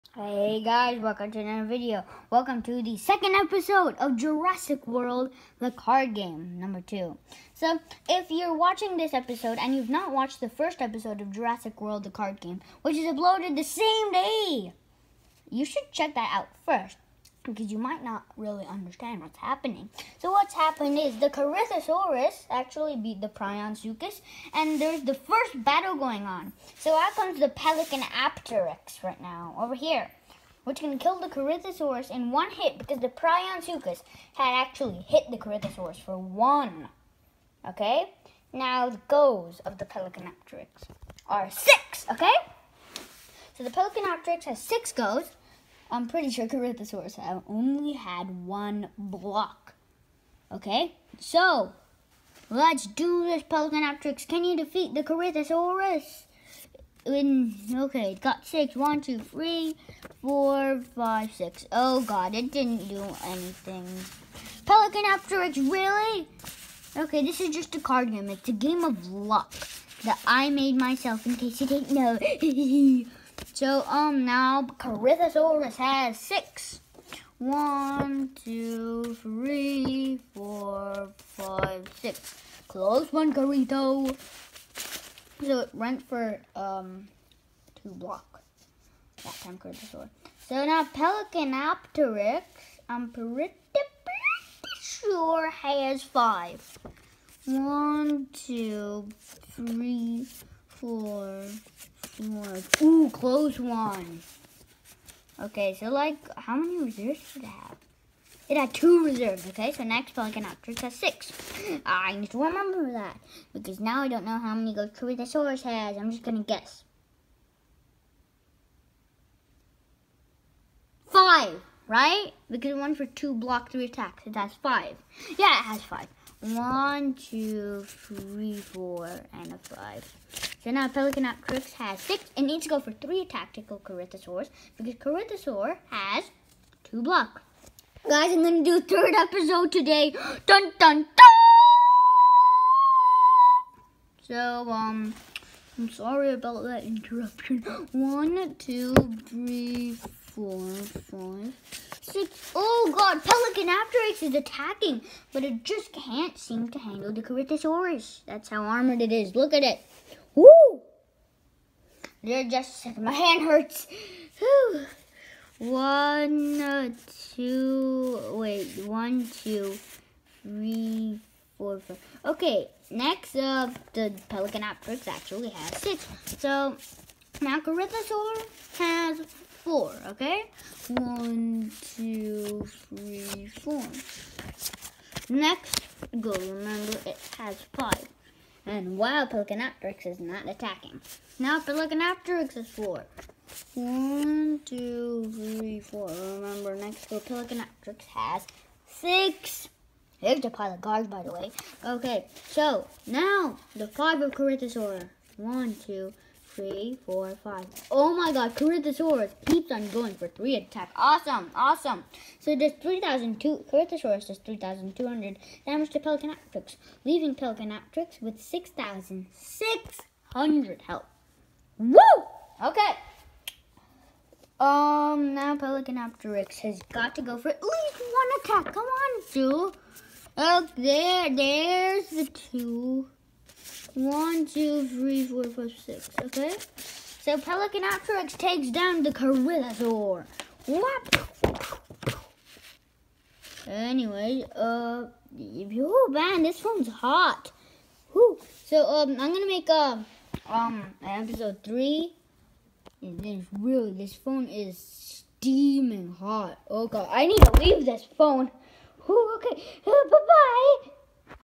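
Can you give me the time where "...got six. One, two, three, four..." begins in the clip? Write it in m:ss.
0:58.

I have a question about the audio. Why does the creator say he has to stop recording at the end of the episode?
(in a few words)
Phone is steaming hot.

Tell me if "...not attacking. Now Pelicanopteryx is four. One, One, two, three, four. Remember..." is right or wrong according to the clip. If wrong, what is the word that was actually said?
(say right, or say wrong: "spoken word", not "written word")
right.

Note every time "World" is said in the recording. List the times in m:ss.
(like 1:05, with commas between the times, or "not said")
0:04, 0:11.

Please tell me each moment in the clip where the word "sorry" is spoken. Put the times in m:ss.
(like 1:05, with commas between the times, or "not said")
2:25.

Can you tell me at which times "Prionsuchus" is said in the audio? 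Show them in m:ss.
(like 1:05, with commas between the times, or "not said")
0:23, 0:33.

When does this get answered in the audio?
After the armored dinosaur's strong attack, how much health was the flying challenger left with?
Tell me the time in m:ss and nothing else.
3:38.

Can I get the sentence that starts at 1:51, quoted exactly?
Ah, I need to remember that because now I don't know how many source has.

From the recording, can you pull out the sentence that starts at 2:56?
So, now Corythosaur has four, okay?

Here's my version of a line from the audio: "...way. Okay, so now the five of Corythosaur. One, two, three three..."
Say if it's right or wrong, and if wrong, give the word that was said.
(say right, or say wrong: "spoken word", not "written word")
right.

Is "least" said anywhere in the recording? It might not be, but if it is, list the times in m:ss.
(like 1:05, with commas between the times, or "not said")
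3:47.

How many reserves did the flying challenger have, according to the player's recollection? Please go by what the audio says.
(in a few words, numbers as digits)
2.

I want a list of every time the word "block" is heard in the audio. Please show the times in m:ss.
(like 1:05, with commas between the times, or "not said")
0:48, 1:27, 2:03, 2:17.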